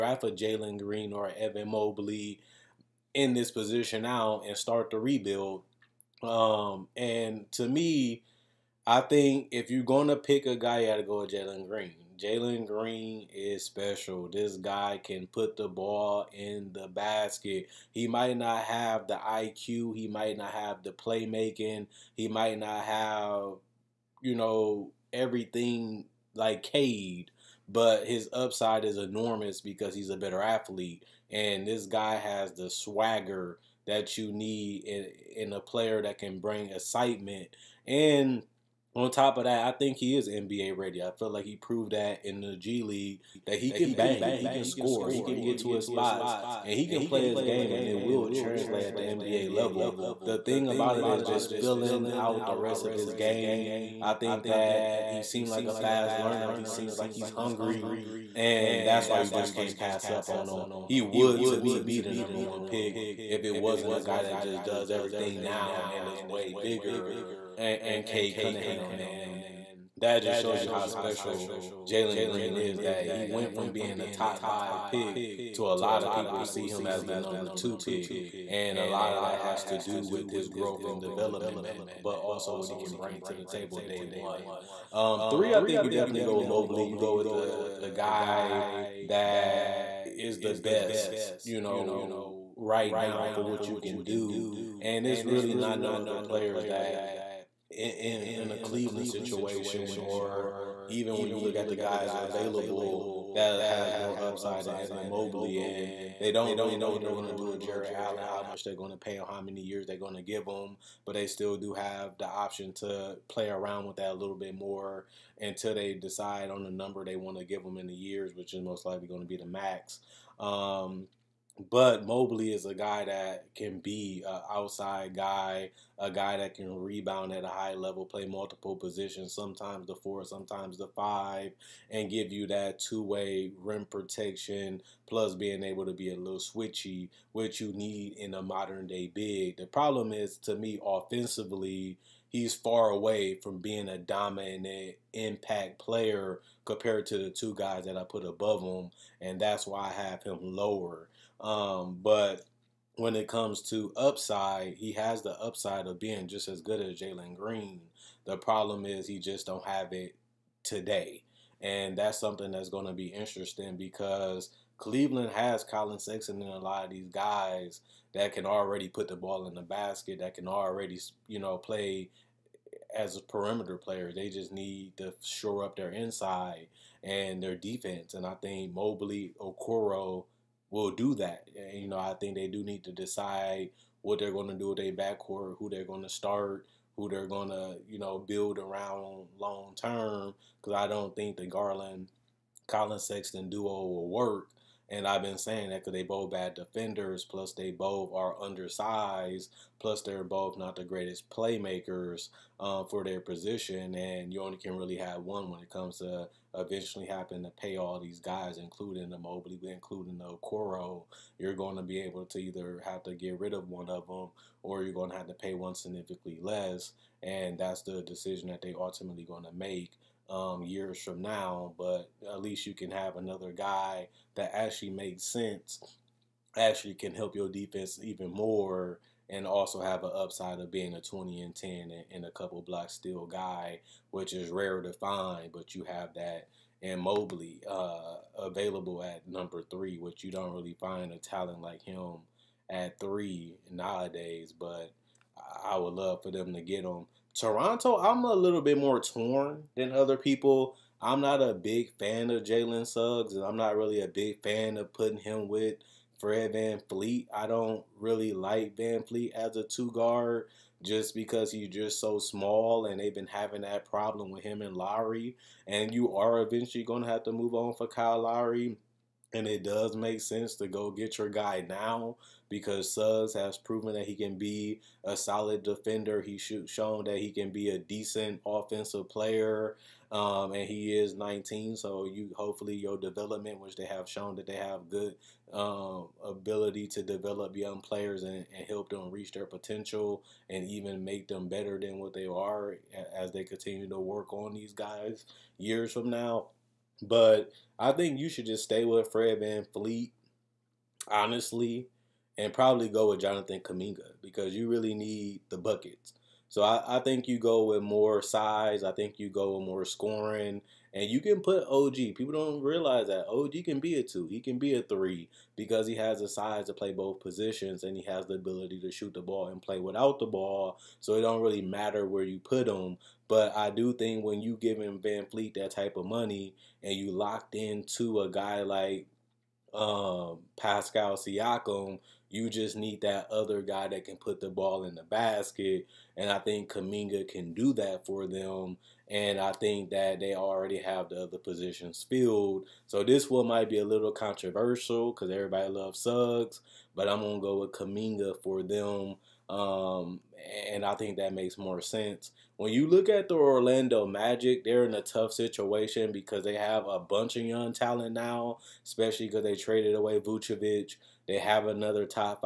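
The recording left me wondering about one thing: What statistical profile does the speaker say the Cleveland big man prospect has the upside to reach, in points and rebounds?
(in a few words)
20 and 10.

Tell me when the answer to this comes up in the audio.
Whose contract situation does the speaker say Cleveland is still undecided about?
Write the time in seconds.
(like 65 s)
107 s.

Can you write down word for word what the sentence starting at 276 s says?
He's shown that he can be a decent offensive player, um, and he is 19.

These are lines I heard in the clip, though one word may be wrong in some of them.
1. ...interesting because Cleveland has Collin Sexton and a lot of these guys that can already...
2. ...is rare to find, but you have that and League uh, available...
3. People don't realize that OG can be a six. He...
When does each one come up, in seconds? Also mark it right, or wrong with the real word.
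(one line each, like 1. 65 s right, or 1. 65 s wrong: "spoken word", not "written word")
1. 163 s right
2. 234 s wrong: "Mobley", not "League"
3. 312 s wrong: "two", not "six".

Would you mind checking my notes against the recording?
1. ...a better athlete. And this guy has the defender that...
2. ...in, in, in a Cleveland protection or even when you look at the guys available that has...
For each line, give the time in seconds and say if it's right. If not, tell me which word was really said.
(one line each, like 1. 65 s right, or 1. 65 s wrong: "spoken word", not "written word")
1. 30 s wrong: "swagger", not "defender"
2. 97 s wrong: "situation", not "protection".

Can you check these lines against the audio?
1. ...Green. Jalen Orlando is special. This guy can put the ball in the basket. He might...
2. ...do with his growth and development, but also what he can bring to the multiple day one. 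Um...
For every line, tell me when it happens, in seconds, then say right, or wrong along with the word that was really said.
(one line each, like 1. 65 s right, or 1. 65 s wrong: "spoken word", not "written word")
1. 11 s wrong: "Green", not "Orlando"
2. 79 s wrong: "table", not "multiple".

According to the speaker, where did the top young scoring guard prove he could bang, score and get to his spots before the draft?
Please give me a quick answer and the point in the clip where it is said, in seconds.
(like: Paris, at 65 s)
G League, at 42 s.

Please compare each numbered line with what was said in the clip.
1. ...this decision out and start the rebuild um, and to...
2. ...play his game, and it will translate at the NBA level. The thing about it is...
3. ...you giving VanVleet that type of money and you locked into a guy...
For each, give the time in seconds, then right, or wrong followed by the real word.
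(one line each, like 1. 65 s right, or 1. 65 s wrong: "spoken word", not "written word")
1. 3 s wrong: "position", not "decision"
2. 47 s right
3. 324 s right.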